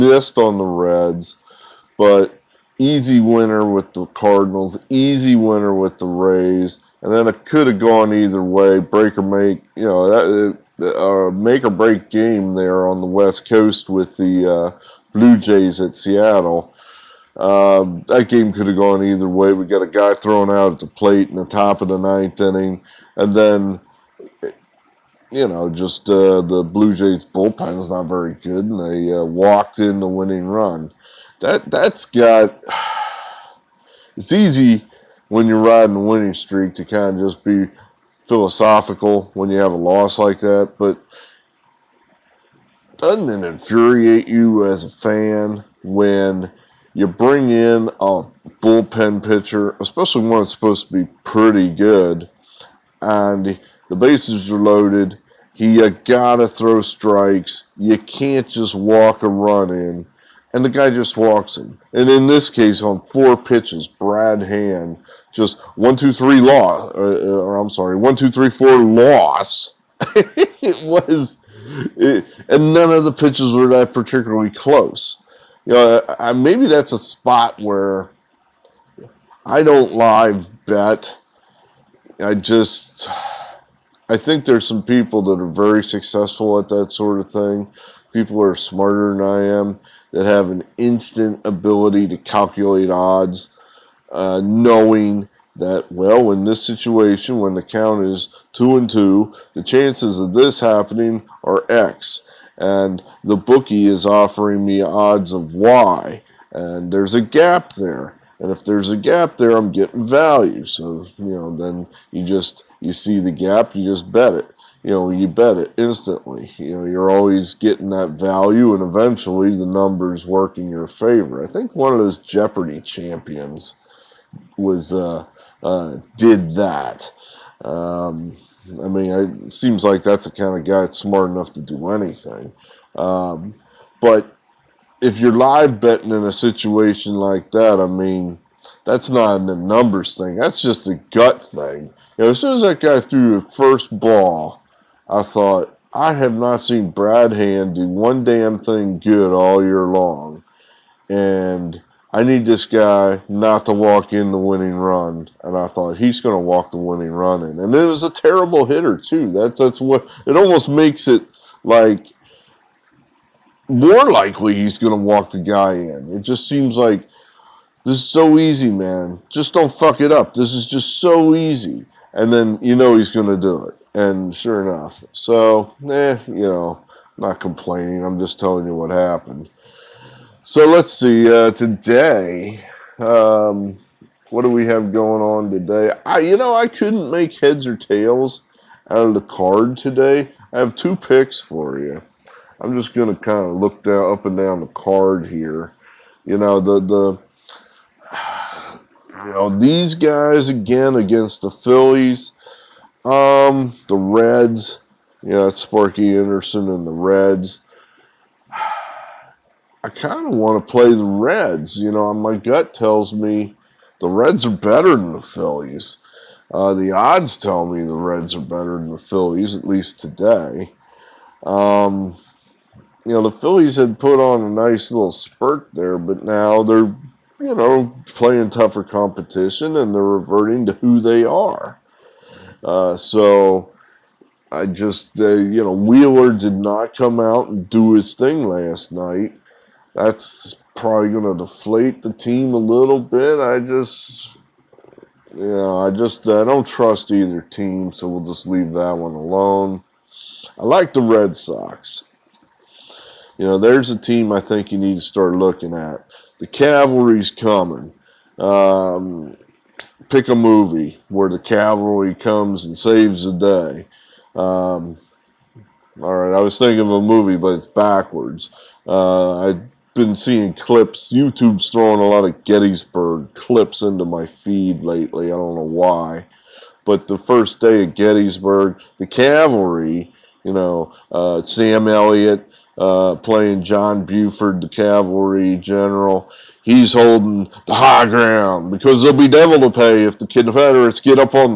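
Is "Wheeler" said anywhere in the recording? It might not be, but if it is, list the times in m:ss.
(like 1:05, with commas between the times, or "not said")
3:55.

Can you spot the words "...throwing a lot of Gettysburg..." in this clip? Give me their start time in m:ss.
4:31.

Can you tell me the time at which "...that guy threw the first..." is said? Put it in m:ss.
2:22.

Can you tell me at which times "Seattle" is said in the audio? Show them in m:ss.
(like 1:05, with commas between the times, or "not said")
0:15.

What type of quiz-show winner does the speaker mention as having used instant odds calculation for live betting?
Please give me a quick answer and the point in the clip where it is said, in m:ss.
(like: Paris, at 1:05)
Jeopardy champions, at 2:02.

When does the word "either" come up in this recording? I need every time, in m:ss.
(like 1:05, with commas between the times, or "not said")
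0:08, 0:19, 4:07.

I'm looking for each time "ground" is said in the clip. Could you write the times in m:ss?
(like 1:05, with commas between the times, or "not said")
4:48.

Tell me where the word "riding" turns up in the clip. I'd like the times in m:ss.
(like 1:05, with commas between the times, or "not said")
0:35.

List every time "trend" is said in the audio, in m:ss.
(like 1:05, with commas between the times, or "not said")
not said.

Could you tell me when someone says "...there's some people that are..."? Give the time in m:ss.
1:24.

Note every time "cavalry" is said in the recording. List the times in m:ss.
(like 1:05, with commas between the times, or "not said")
4:16, 4:21, 4:39, 4:44.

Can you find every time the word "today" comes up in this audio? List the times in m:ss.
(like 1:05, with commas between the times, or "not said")
3:01, 3:05, 3:09, 3:39.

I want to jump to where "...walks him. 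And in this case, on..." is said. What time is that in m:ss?
1:01.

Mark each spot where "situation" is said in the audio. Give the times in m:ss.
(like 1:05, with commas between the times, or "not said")
1:36, 2:16.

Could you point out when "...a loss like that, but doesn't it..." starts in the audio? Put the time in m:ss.
0:39.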